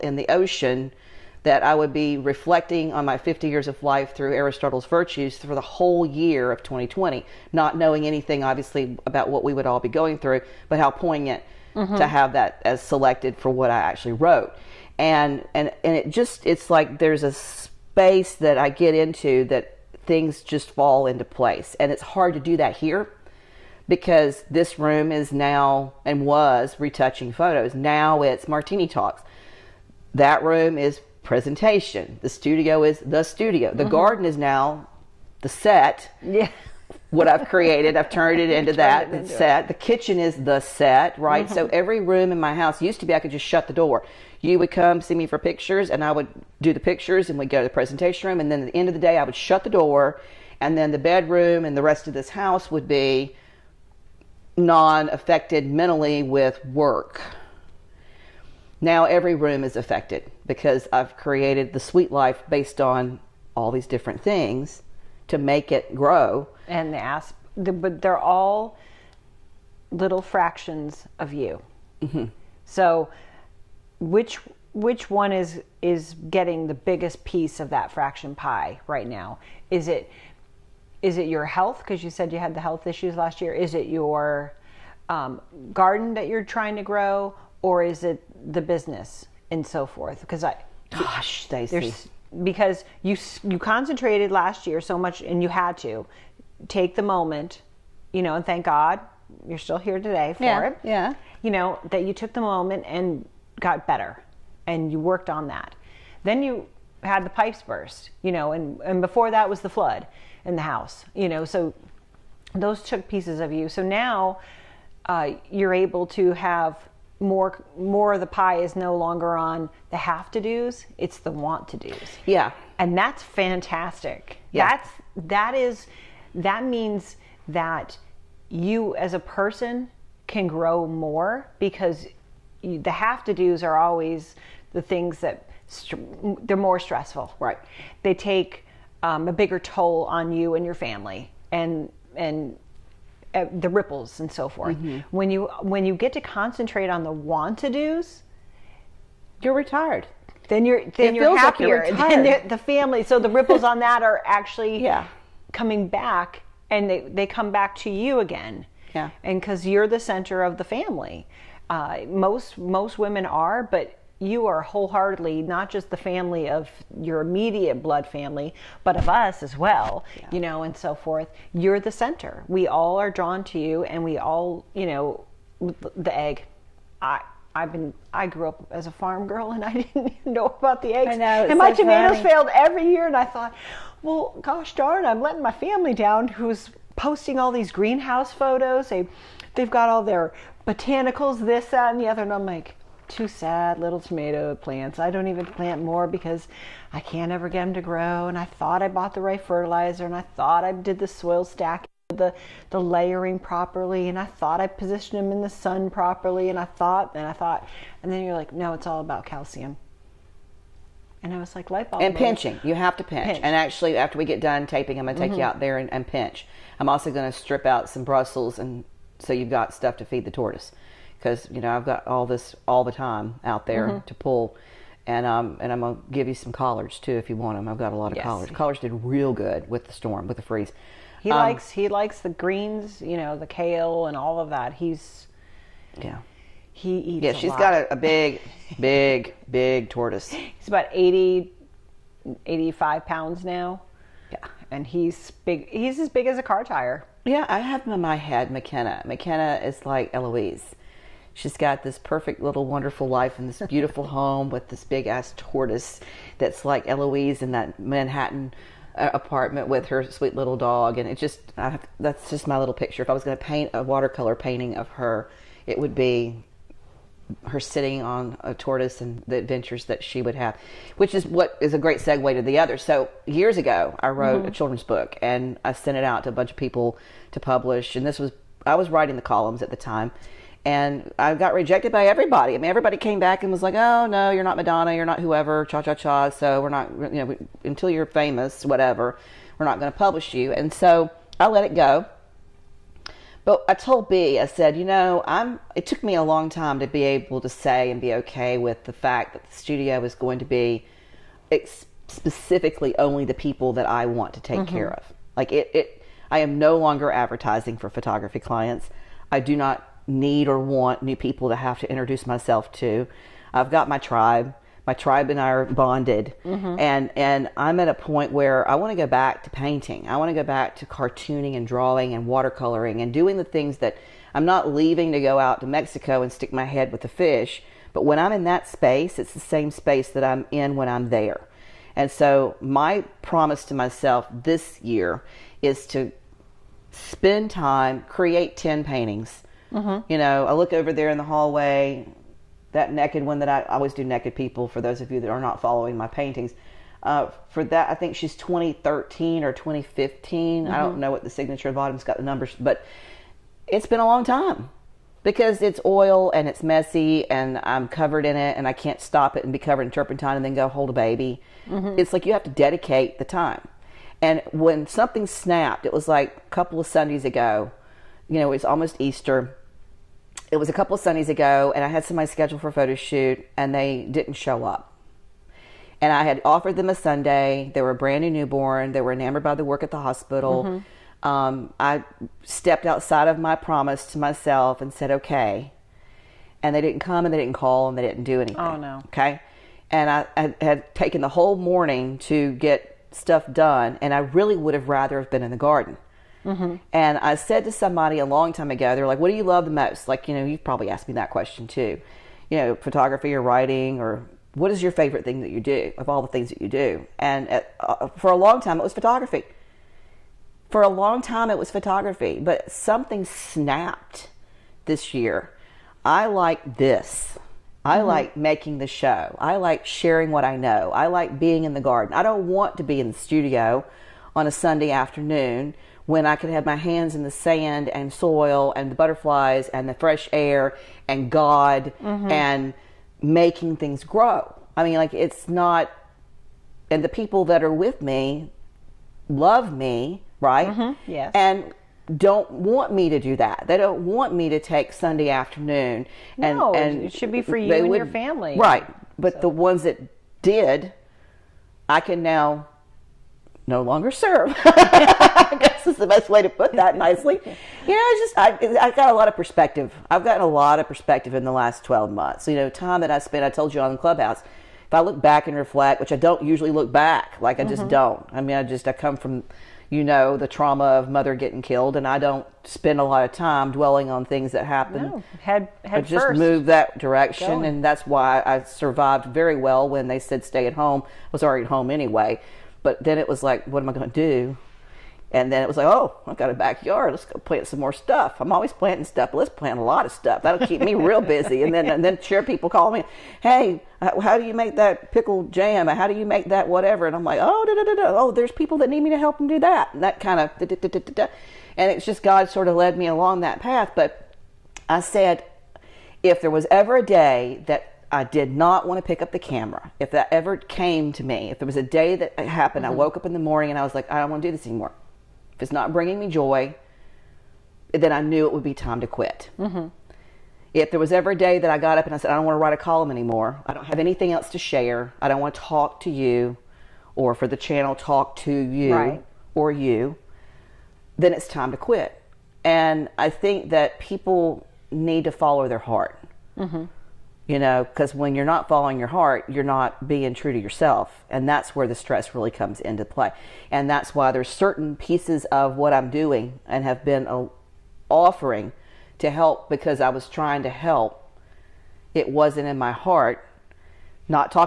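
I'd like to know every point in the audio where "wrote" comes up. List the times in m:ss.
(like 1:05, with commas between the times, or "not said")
0:14, 4:34.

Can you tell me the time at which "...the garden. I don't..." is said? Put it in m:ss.
7:01.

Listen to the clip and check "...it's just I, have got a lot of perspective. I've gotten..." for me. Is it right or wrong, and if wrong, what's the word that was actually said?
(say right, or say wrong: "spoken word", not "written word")
right.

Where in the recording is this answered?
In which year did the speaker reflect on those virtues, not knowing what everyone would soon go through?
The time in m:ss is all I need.
0:06.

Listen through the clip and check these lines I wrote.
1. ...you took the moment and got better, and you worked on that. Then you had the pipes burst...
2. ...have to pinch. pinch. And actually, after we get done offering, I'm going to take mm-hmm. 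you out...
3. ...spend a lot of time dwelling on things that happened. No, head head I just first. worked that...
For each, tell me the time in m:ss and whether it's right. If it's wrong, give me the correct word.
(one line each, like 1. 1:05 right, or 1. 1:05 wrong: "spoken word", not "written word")
1. 1:42 right
2. 3:32 wrong: "taping", not "offering"
3. 7:52 wrong: "moved", not "worked".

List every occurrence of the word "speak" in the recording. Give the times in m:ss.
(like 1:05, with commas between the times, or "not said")
not said.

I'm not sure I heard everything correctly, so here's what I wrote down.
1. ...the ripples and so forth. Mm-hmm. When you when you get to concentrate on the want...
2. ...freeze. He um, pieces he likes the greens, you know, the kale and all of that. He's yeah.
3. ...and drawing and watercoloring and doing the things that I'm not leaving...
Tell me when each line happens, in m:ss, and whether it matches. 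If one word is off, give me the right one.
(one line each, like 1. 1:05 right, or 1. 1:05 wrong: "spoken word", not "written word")
1. 2:23 right
2. 3:50 wrong: "likes", not "pieces"
3. 5:21 right.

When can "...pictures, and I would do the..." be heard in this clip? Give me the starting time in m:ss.
0:45.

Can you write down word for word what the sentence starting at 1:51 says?
So those took pieces of you.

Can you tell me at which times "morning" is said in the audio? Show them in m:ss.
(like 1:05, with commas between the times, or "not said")
6:31, 8:33.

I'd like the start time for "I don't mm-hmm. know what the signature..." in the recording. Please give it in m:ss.
5:50.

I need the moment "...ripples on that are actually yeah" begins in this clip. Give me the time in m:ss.
2:33.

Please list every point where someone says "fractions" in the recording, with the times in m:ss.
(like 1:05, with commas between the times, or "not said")
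1:10, 1:17.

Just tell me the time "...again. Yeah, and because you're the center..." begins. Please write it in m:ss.
2:38.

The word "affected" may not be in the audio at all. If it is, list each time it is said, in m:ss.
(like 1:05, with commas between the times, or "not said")
0:55, 0:59.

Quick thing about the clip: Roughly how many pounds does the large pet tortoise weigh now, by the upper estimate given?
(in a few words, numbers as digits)
85 pounds.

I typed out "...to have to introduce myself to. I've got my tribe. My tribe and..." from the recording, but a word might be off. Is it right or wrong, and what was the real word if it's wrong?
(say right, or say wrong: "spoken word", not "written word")
right.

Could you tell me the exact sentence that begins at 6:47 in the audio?
And at, uh, uh, for a long time, it was photography.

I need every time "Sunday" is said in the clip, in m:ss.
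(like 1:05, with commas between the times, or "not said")
6:06, 6:10, 6:16, 7:04, 7:24.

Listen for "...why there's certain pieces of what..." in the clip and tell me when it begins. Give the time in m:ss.
9:04.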